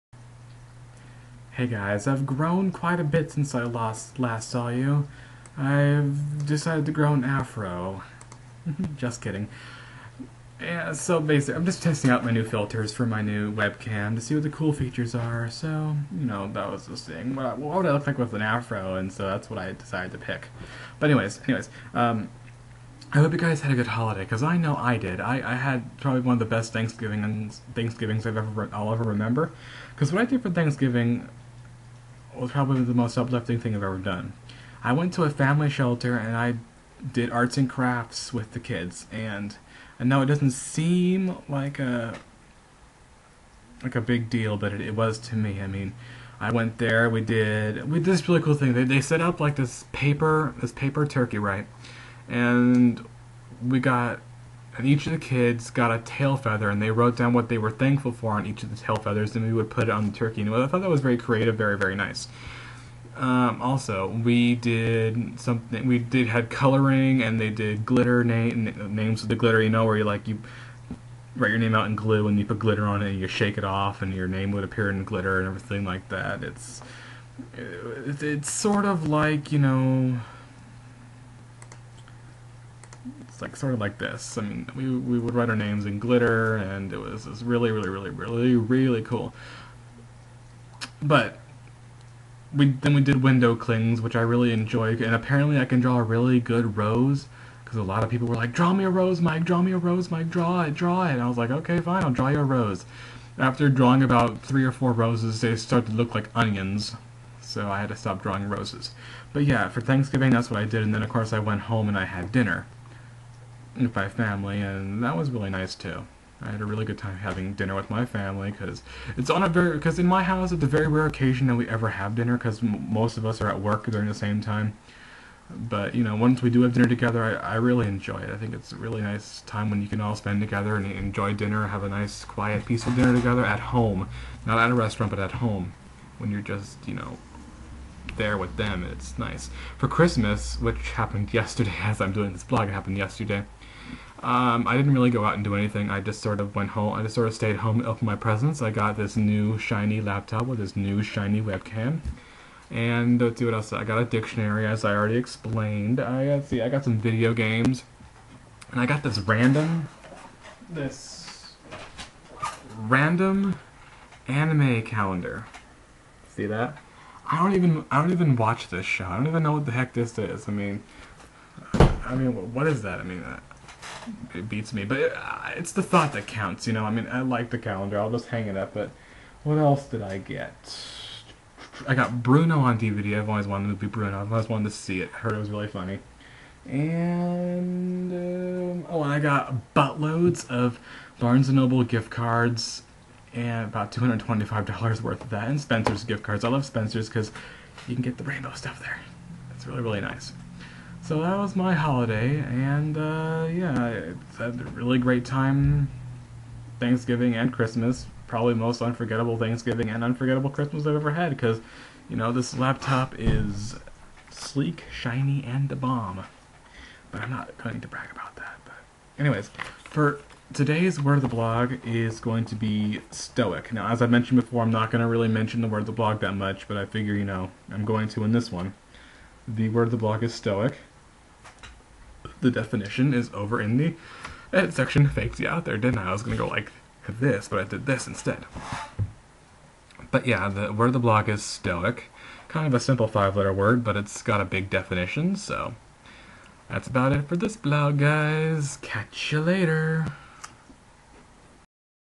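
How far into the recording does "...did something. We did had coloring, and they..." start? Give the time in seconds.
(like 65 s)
64 s.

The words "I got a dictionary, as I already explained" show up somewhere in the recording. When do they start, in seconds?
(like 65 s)
153 s.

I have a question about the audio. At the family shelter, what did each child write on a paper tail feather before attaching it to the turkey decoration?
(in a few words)
What they were thankful for.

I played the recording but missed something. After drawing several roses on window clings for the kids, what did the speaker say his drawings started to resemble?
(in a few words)
Onions.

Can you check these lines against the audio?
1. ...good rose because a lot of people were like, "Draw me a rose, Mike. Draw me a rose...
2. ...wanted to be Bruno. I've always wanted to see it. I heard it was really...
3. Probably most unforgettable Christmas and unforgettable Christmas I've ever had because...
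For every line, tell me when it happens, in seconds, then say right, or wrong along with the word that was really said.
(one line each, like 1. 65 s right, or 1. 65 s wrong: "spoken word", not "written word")
1. 96 s right
2. 183 s right
3. 208 s wrong: "Thanksgiving", not "Christmas".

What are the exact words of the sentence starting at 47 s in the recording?
We did we did this really cool thing.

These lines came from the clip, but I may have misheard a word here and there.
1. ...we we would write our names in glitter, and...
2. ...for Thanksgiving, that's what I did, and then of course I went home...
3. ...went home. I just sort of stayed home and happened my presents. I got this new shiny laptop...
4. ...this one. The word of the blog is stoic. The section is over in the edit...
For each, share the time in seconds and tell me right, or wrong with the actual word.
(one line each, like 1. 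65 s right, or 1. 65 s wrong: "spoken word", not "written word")
1. 84 s right
2. 109 s right
3. 146 s wrong: "opened", not "happened"
4. 228 s wrong: "definition", not "section".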